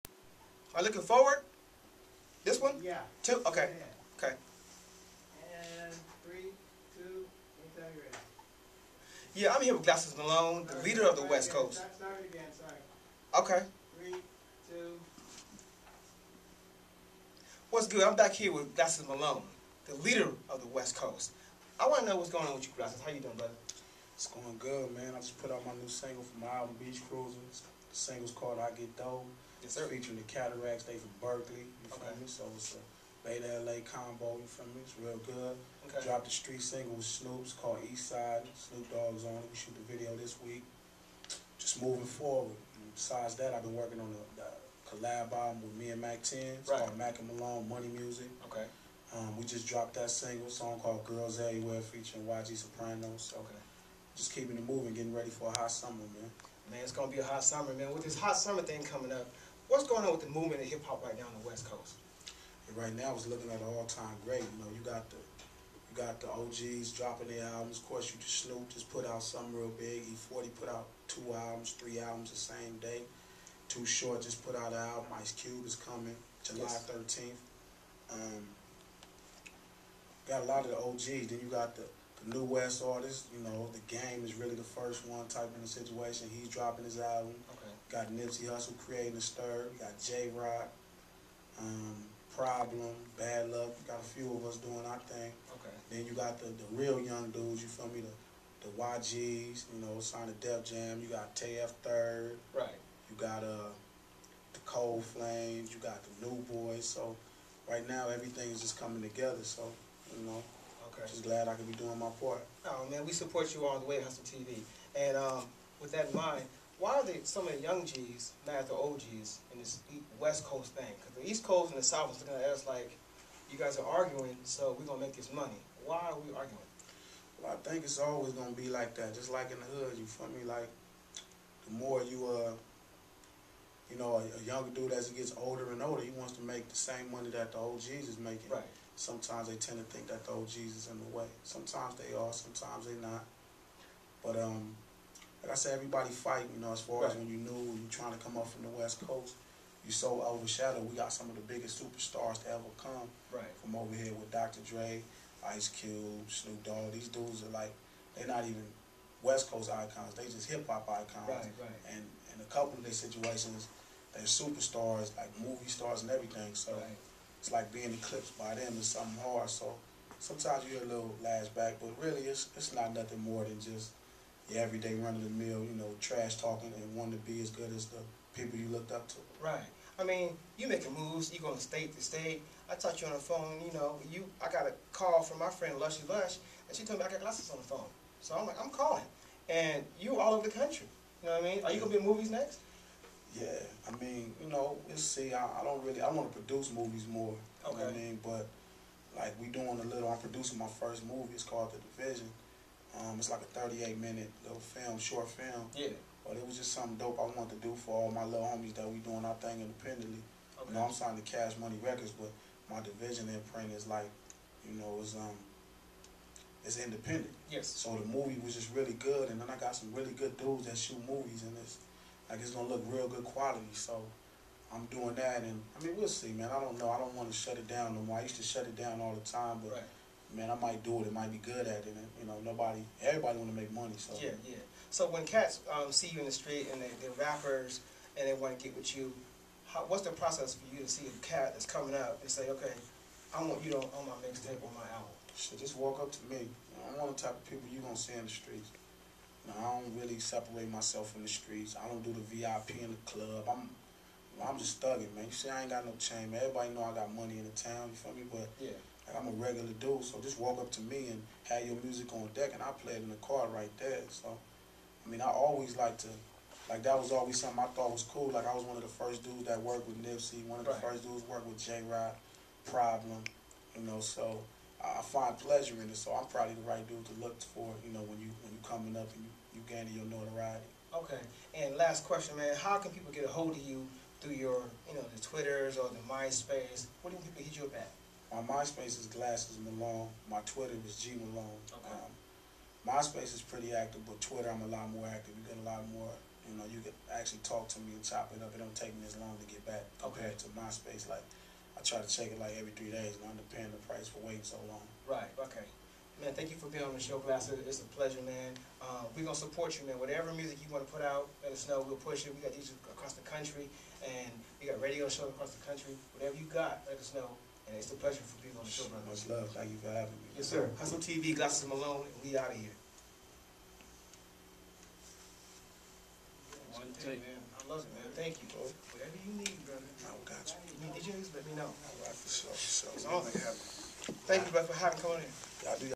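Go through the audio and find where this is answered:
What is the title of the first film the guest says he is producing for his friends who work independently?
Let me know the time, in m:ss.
3:21.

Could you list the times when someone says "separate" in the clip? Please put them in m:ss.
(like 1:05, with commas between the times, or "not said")
4:10.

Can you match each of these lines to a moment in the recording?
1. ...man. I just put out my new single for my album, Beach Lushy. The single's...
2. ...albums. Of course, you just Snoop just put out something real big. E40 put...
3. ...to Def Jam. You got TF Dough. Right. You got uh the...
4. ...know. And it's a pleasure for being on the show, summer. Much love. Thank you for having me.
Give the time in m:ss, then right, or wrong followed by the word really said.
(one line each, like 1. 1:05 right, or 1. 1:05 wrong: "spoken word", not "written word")
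1. 0:24 wrong: "Cruisers", not "Lushy"
2. 1:07 right
3. 1:40 wrong: "Third", not "Dough"
4. 5:17 wrong: "brother", not "summer".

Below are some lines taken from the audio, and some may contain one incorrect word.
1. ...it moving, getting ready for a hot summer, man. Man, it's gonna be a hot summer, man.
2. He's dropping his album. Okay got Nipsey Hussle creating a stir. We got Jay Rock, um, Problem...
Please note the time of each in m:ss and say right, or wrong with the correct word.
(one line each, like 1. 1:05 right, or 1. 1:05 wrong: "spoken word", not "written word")
1. 0:54 right
2. 1:26 right.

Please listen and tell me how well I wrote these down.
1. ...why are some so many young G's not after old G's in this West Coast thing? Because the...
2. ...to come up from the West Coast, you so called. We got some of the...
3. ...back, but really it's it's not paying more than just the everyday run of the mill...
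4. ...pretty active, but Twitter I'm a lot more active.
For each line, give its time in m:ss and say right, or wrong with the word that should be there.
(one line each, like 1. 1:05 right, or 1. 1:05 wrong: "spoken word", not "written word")
1. 1:56 right
2. 2:28 wrong: "overshadowed", not "called"
3. 2:51 wrong: "nothing", not "paying"
4. 4:53 right.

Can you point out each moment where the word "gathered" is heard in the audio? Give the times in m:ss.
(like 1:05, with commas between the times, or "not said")
not said.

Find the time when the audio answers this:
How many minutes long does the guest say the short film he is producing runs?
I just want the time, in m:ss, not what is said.
3:23.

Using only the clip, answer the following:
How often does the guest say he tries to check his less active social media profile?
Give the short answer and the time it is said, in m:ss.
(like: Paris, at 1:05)
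Every 3 days, at 5:02.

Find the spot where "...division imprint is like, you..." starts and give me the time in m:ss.
3:32.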